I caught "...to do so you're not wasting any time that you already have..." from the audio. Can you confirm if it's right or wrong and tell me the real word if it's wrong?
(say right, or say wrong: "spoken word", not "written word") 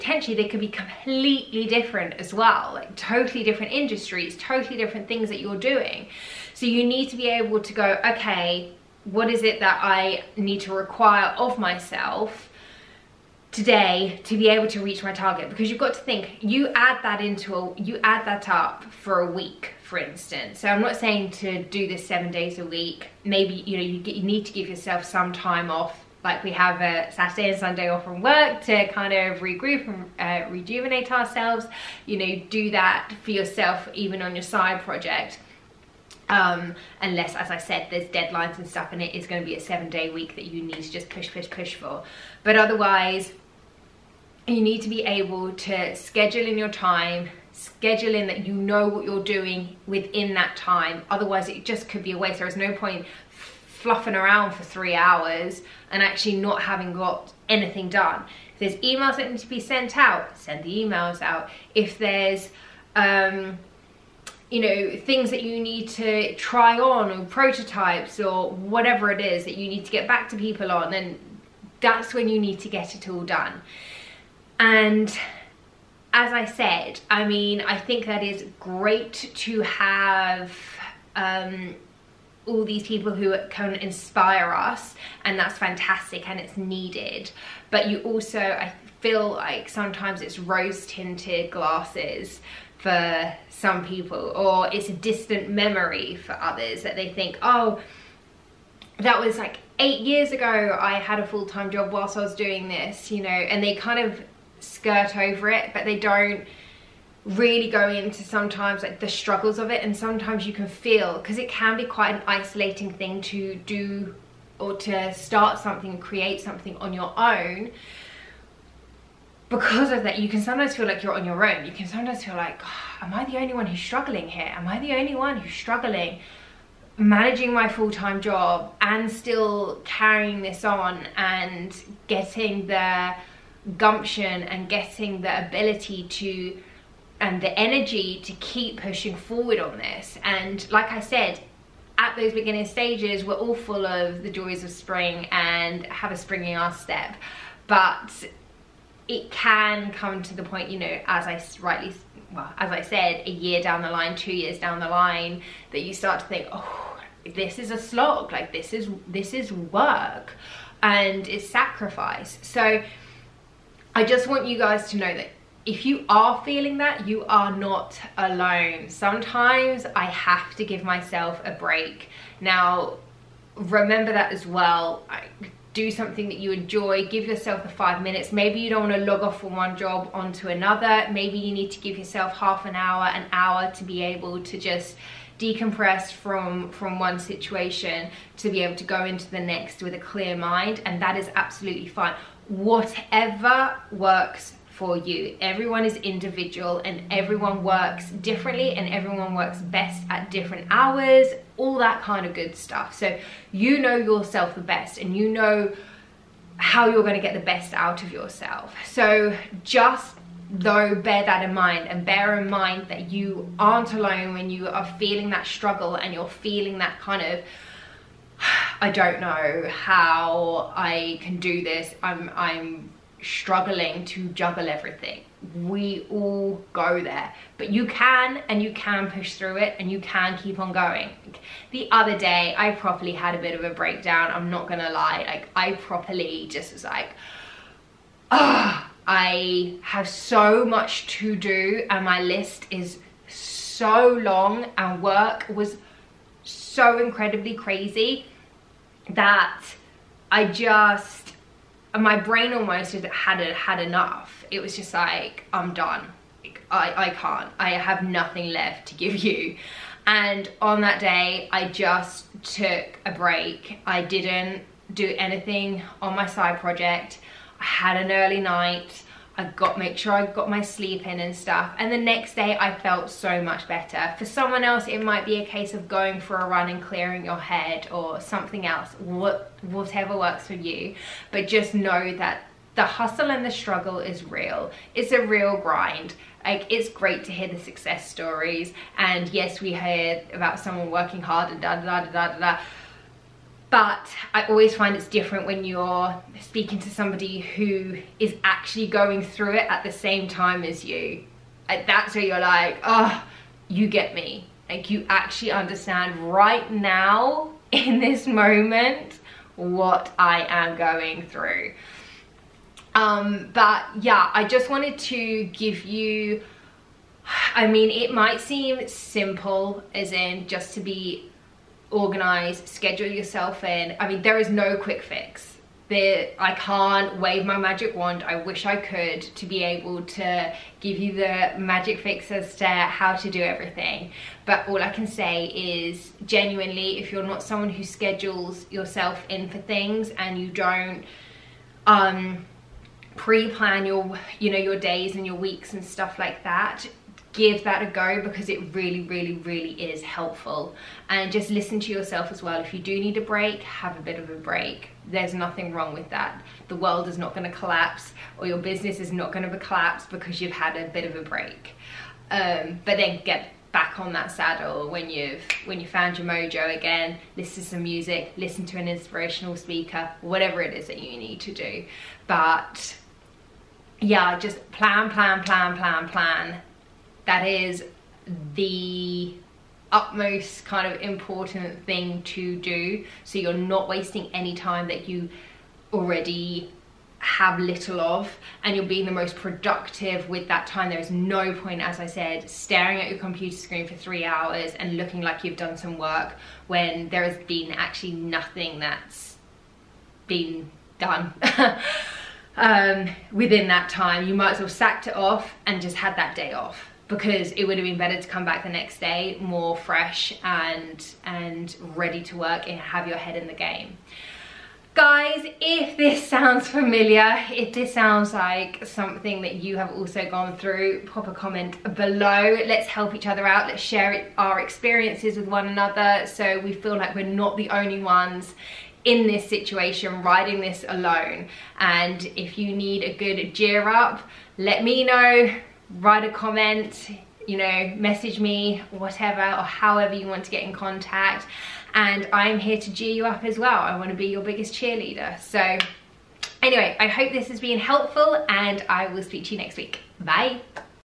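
right.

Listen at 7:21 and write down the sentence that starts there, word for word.
And I'm here to cheer you up as well.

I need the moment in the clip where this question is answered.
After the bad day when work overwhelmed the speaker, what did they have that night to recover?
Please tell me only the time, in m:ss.
4:28.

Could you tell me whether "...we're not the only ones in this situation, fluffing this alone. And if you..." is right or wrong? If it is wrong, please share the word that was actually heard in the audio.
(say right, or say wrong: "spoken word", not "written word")
wrong: "riding", not "fluffing".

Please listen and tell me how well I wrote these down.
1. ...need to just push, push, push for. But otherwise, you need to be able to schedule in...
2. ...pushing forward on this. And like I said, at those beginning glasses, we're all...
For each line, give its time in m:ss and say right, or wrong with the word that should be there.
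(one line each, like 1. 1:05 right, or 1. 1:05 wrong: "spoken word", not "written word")
1. 0:40 right
2. 2:18 wrong: "stages", not "glasses".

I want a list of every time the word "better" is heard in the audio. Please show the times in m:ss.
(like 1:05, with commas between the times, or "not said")
4:33, 6:47.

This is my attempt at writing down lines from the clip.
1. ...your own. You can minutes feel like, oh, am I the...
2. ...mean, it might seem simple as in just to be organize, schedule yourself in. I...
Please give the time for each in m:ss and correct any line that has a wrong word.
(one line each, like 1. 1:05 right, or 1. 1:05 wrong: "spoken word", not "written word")
1. 2:01 wrong: "sometimes", not "minutes"
2. 5:17 right.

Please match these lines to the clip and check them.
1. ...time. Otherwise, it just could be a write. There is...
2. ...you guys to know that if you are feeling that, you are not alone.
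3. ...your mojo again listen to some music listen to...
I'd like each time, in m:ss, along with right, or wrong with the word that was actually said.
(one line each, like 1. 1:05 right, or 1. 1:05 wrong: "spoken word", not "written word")
1. 0:50 wrong: "waste", not "write"
2. 2:44 right
3. 6:06 right.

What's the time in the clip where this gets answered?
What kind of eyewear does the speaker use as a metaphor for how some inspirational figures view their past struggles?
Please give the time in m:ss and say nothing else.
1:30.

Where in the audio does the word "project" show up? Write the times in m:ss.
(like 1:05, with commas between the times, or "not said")
0:34, 4:26.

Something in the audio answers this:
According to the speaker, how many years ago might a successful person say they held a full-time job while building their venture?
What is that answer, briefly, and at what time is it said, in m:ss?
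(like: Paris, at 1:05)
8, at 1:39.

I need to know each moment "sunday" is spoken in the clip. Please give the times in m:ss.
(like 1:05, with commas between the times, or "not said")
0:27.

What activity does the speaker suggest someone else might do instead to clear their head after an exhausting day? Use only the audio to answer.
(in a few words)
going for a run.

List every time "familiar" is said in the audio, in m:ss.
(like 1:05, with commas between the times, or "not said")
6:56.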